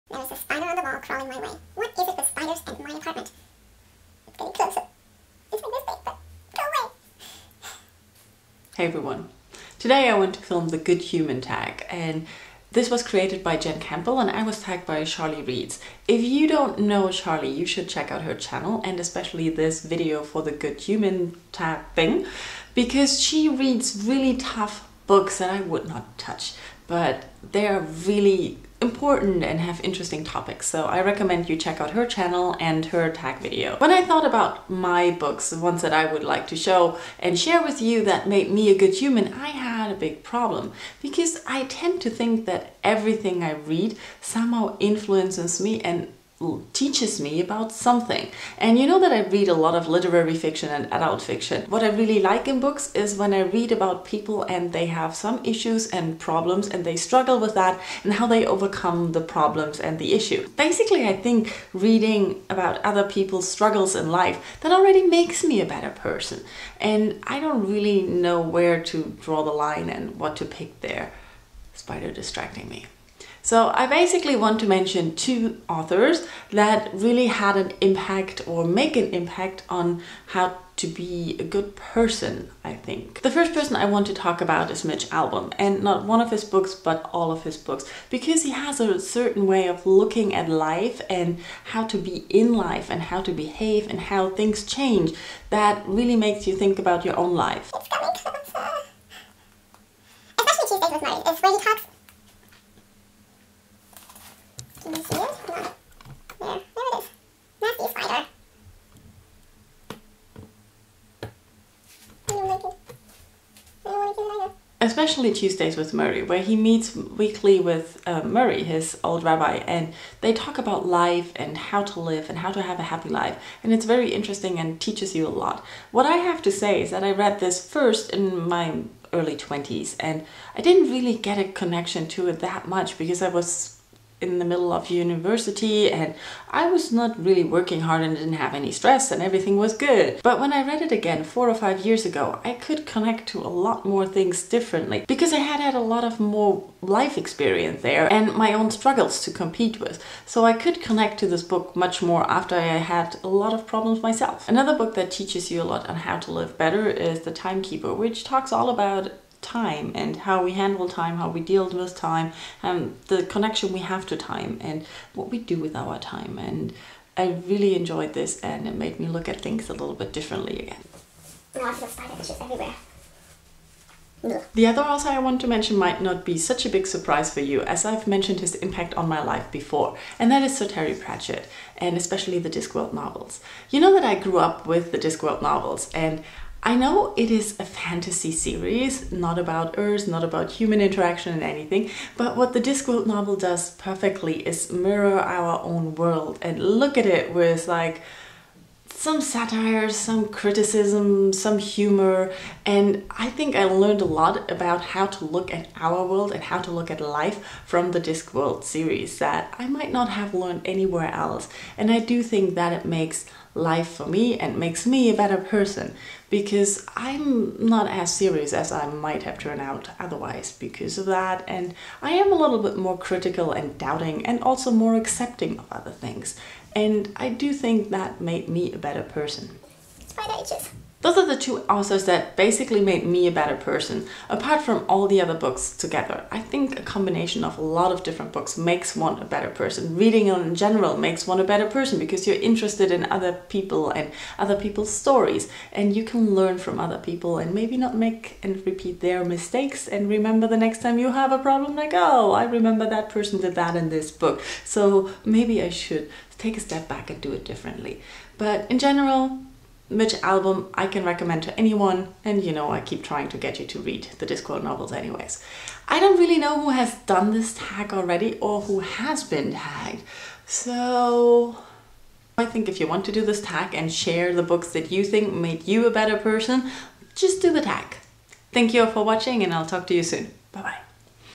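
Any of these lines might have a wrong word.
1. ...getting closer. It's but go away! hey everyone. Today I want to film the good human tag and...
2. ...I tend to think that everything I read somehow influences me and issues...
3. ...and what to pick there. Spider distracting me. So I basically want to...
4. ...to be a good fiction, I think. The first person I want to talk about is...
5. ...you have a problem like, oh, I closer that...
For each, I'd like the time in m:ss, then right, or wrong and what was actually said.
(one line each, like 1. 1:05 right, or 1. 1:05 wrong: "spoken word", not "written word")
1. 0:04 right
2. 0:41 wrong: "teaches", not "issues"
3. 1:09 right
4. 1:20 wrong: "person", not "fiction"
5. 4:10 wrong: "remember", not "closer".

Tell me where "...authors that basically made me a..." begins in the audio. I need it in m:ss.
3:51.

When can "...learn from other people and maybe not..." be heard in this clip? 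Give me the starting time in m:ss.
4:06.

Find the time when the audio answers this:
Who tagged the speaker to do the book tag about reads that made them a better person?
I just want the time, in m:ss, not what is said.
0:15.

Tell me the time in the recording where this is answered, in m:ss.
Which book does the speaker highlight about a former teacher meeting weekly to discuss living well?
1:55.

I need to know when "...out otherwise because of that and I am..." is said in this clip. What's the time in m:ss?
3:39.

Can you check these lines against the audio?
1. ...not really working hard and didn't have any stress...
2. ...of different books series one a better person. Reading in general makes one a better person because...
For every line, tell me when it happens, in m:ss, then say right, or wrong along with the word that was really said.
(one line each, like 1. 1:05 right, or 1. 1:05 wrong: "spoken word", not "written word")
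1. 2:16 right
2. 3:57 wrong: "makes", not "series".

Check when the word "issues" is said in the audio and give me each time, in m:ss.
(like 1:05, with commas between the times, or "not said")
0:55, 1:00.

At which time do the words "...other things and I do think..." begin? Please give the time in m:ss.
3:45.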